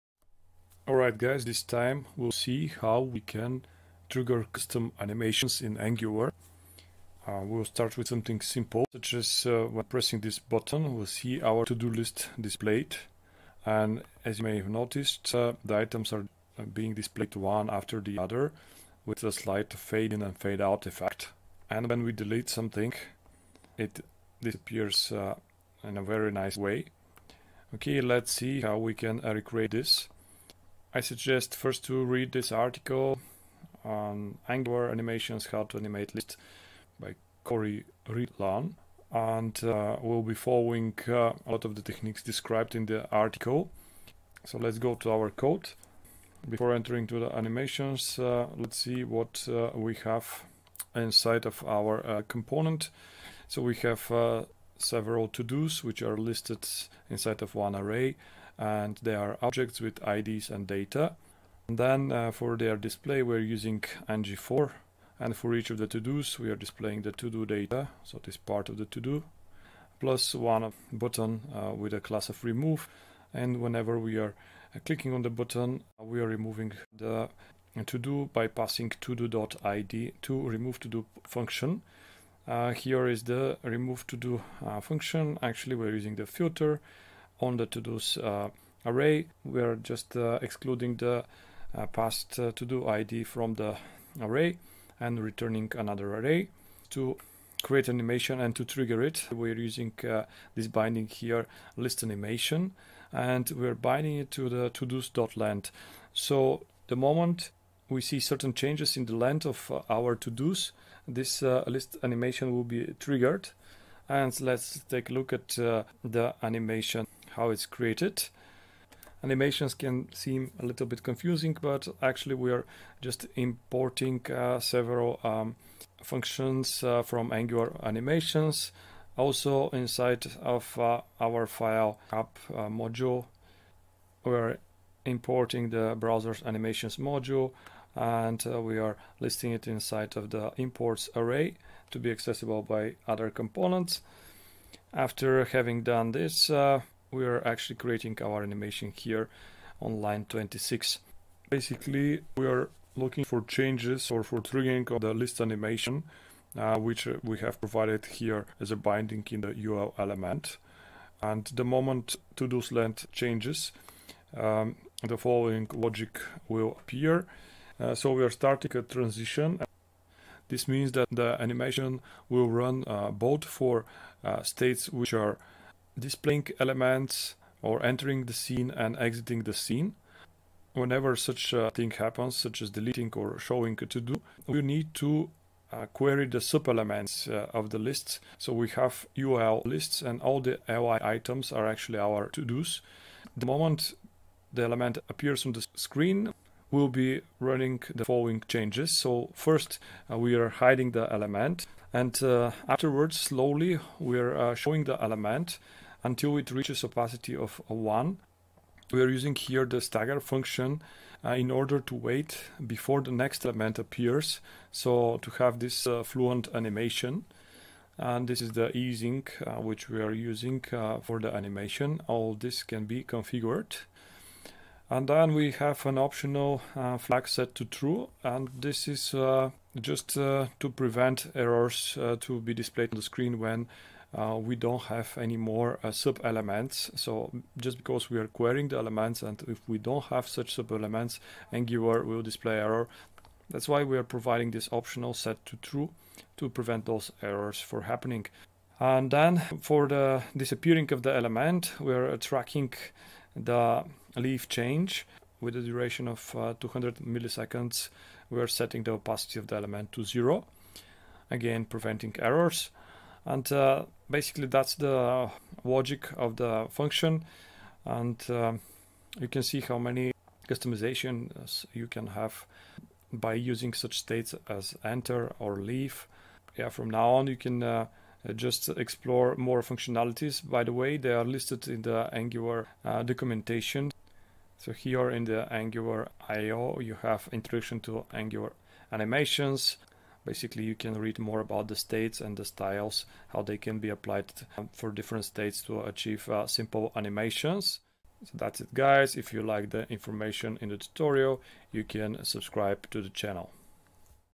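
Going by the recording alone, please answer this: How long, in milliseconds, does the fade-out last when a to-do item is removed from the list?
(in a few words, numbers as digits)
200.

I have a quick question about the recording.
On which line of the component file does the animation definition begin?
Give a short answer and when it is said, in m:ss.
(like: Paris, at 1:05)
26, at 2:30.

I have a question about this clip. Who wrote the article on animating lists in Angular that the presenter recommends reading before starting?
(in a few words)
Cory Rylan.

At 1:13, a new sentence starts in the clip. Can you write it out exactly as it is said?
And whenever we are uh, clicking on the button, we are removing the to-do by passing to-do.id to remove to-do function.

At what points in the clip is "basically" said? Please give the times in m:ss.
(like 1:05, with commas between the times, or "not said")
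2:31, 4:24, 4:50.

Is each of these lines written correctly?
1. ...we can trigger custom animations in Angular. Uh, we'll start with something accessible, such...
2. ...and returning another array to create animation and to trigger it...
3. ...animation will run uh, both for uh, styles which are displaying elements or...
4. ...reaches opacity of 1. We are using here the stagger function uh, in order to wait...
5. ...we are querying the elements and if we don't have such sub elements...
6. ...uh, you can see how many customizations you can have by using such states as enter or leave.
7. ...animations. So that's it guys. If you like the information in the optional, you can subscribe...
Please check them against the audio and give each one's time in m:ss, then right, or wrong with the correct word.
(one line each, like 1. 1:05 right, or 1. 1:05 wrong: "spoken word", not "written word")
1. 0:02 wrong: "simple", not "accessible"
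2. 1:34 right
3. 2:51 wrong: "states", not "styles"
4. 3:26 right
5. 3:58 right
6. 4:28 right
7. 4:56 wrong: "tutorial", not "optional".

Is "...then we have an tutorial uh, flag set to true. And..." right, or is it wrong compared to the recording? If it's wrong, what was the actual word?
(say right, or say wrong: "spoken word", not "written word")
wrong: "optional", not "tutorial".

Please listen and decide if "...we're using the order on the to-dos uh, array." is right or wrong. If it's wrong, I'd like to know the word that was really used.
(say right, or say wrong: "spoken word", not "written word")
wrong: "filter", not "order".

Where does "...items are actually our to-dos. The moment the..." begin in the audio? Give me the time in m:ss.
3:11.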